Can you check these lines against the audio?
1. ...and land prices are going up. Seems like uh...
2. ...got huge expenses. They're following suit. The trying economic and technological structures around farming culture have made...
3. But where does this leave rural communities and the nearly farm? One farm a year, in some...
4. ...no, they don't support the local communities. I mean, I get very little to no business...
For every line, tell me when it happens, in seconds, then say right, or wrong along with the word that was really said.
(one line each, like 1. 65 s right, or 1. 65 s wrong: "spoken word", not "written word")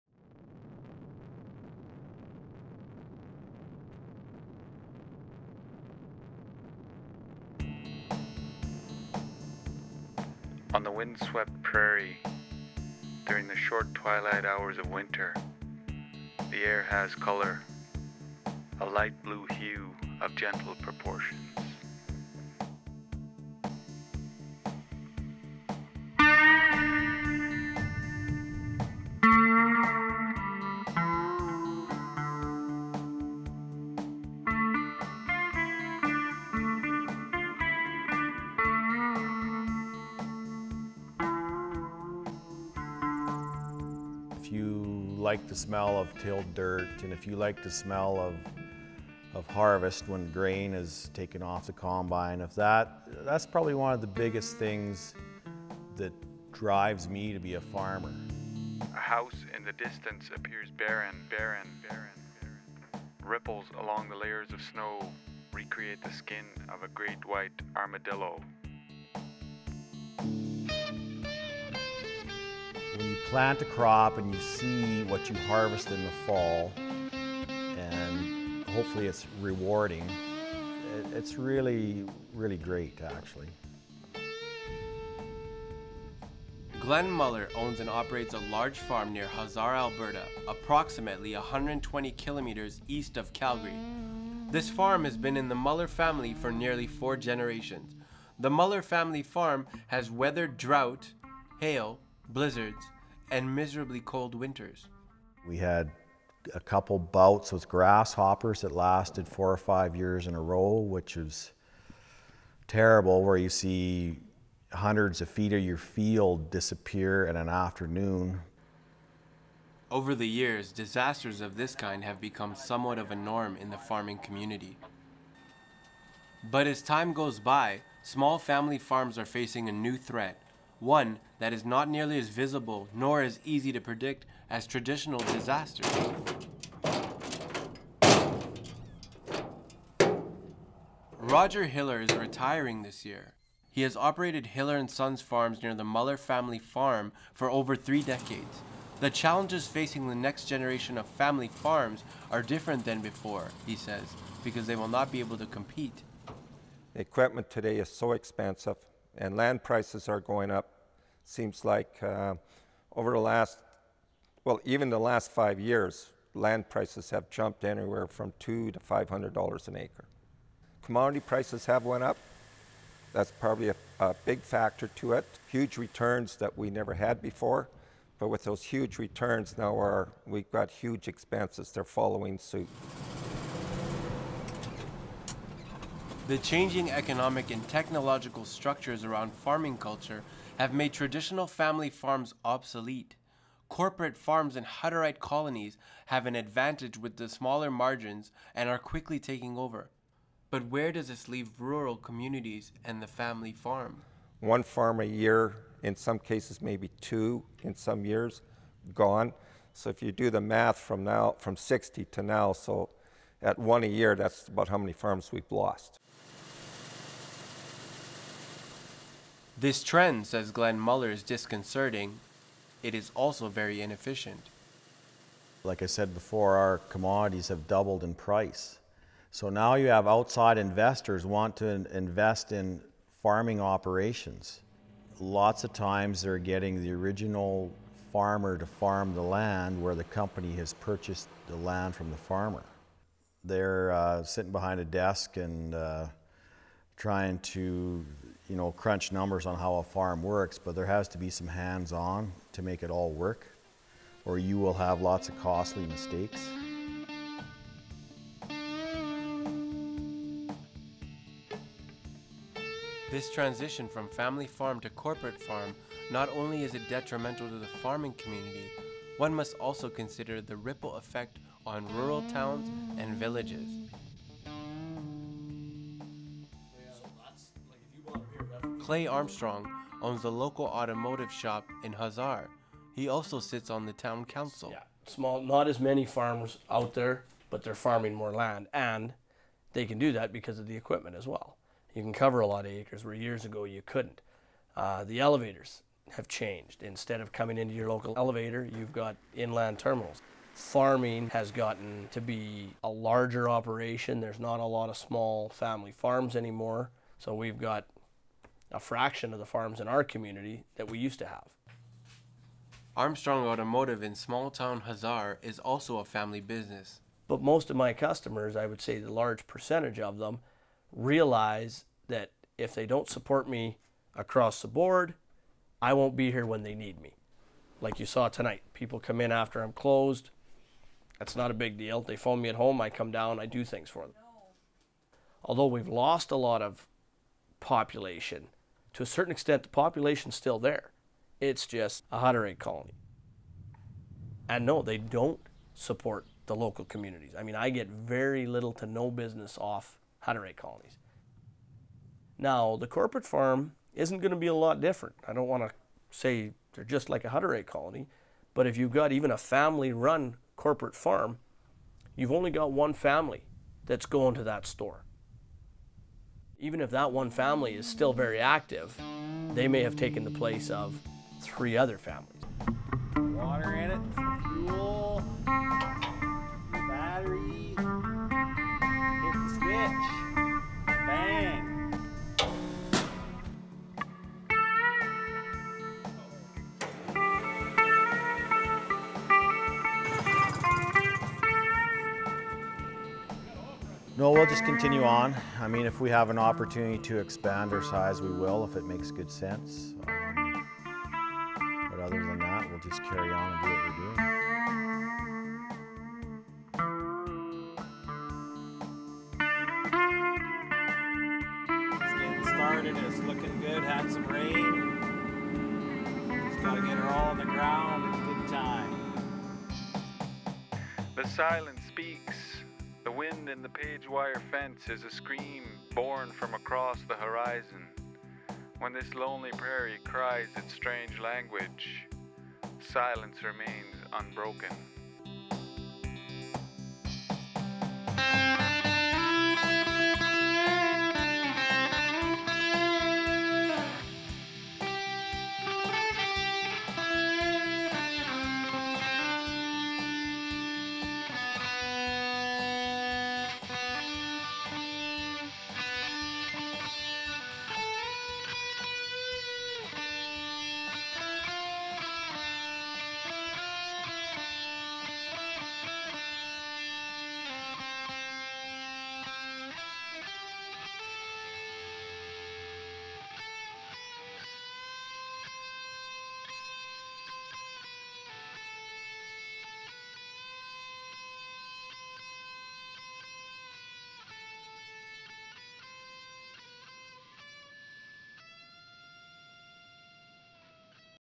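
1. 159 s right
2. 180 s wrong: "changing", not "trying"
3. 200 s wrong: "family", not "nearly"
4. 344 s right.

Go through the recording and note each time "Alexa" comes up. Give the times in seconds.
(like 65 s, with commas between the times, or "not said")
not said.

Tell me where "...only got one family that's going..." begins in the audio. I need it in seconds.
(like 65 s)
362 s.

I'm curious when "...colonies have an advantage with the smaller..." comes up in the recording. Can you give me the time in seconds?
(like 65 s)
195 s.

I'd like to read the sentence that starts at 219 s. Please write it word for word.
This trend, says Glenn Muller, is disconcerting.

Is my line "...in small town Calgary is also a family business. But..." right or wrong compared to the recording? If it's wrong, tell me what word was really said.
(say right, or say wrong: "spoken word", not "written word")
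wrong: "Hussar", not "Calgary".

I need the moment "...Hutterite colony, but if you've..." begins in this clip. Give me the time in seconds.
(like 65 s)
357 s.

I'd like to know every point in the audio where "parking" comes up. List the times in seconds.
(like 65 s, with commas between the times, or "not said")
not said.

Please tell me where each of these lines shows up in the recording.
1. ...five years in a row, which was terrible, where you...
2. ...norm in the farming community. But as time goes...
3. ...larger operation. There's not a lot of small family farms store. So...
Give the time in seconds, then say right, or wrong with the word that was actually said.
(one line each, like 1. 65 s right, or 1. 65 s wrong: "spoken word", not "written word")
1. 109 s right
2. 123 s right
3. 302 s wrong: "anymore", not "store".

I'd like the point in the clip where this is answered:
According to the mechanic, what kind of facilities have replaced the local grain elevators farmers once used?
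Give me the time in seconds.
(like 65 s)
299 s.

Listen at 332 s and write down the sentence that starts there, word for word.
They phone me at home, I come down, I do things for them.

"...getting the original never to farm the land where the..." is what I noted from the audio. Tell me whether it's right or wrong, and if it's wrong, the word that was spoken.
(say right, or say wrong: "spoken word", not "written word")
wrong: "farmer", not "never".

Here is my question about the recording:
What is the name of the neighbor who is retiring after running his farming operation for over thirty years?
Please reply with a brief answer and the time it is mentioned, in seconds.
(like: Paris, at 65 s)
Roger Hiller, at 141 s.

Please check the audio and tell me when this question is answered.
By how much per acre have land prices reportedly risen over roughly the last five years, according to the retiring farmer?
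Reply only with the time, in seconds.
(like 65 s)
168 s.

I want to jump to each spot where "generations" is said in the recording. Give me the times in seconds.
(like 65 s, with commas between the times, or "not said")
97 s, 150 s.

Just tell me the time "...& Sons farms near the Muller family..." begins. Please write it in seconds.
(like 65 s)
144 s.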